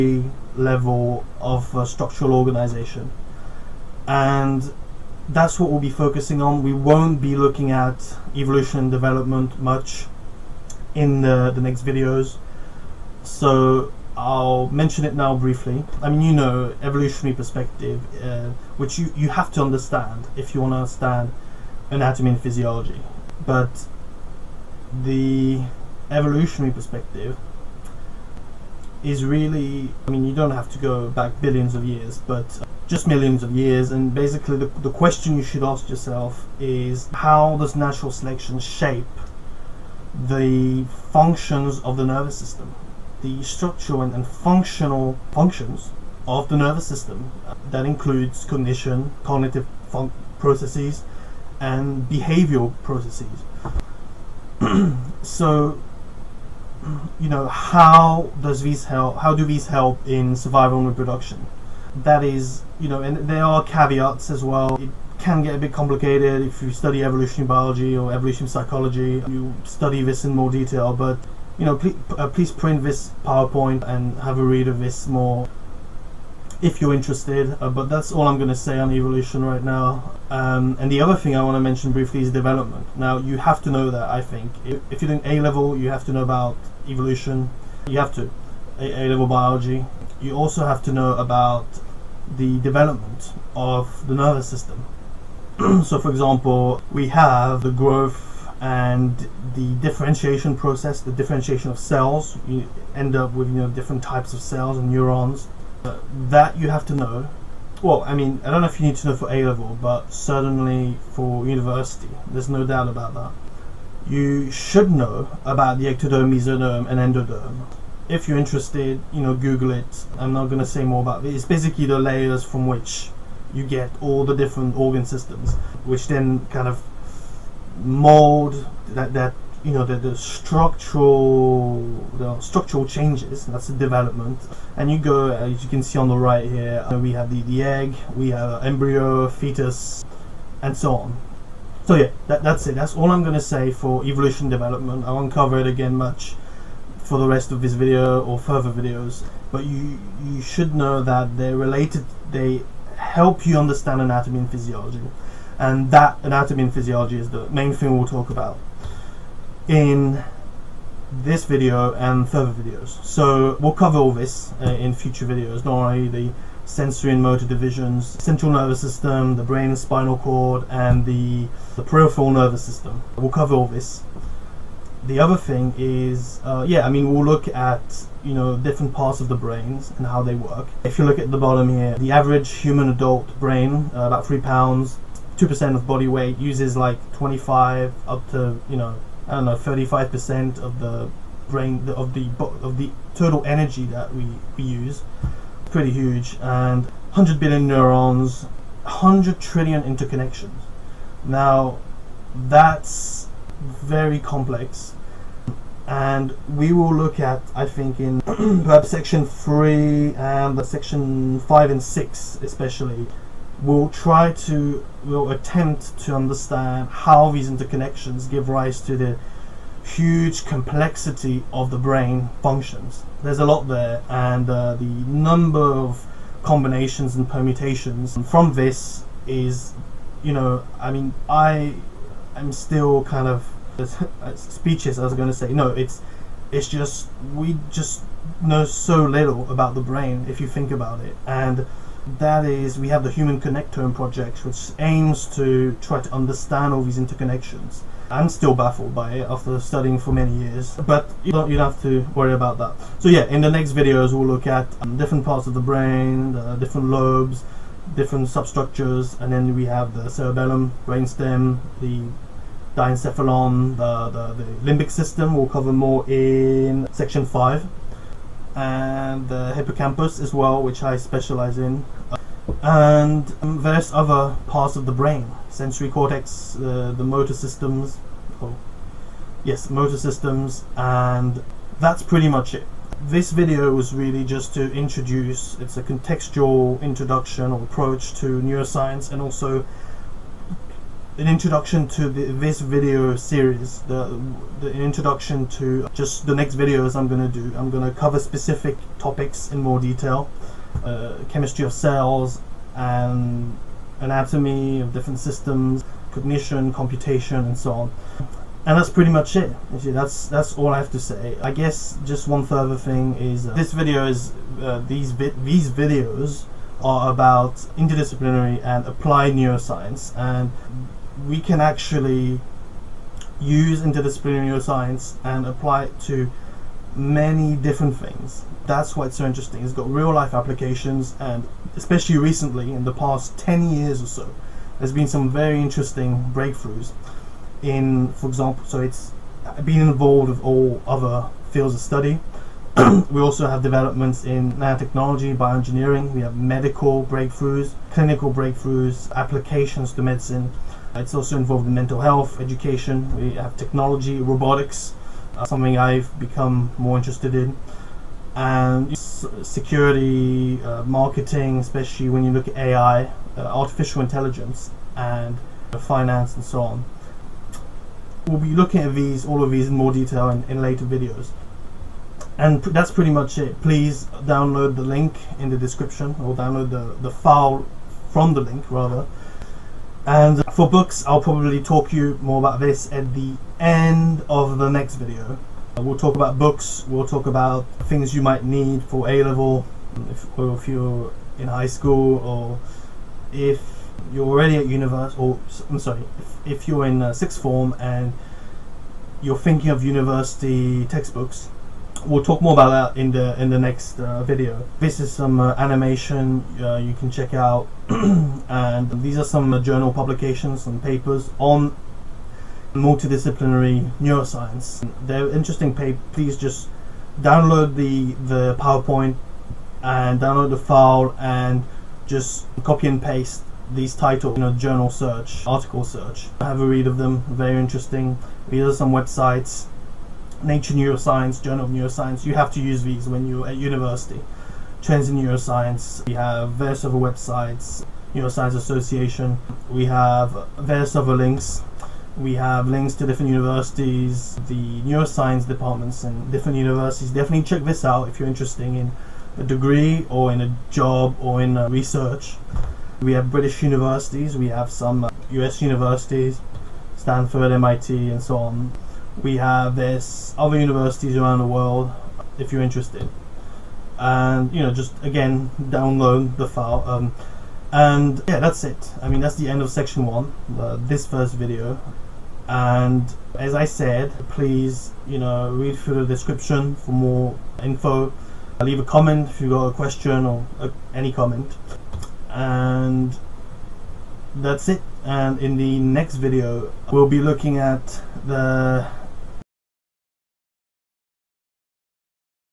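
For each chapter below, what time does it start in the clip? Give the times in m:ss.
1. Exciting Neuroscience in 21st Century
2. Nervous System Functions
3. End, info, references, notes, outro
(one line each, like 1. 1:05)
1. 5:04
2. 2:44
3. 6:12.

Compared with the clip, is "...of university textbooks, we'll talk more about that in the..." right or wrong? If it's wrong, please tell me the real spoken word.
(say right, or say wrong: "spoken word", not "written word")
right.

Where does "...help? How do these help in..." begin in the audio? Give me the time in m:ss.
0:58.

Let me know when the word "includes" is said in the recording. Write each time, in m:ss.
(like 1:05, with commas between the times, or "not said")
0:47.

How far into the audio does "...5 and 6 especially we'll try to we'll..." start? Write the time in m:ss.
3:31.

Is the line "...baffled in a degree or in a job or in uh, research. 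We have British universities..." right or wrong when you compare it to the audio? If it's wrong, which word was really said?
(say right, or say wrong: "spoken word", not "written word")
wrong: "interested", not "baffled".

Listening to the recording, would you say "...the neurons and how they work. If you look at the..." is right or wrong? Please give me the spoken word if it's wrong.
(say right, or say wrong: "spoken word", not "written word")
wrong: "brains", not "neurons".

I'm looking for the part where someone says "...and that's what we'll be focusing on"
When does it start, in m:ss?
0:04.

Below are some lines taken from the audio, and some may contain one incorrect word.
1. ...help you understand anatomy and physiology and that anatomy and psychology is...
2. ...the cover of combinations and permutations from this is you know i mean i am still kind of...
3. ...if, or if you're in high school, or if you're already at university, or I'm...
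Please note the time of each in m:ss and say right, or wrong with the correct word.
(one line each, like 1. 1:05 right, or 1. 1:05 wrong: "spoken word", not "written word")
1. 2:32 wrong: "physiology", not "psychology"
2. 3:44 wrong: "number", not "cover"
3. 6:30 right.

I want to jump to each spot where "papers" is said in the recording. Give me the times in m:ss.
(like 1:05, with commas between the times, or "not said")
6:50, 6:55.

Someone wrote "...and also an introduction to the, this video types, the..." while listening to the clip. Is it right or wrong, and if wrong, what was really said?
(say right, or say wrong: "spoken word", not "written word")
wrong: "series", not "types".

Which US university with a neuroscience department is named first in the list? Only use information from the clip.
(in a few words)
Stanford.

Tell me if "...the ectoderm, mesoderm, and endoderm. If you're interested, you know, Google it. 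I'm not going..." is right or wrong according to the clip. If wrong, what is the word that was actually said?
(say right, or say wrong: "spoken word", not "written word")
right.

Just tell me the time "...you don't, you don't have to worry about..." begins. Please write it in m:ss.
4:11.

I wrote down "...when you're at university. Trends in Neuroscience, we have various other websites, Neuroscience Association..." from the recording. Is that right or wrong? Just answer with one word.
right.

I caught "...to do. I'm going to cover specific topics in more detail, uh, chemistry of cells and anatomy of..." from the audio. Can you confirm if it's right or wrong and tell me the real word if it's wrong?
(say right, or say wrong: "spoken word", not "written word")
right.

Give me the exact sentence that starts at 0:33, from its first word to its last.
And basically, the, the question you should ask yourself is how does natural selection shape the functions of the nervous system?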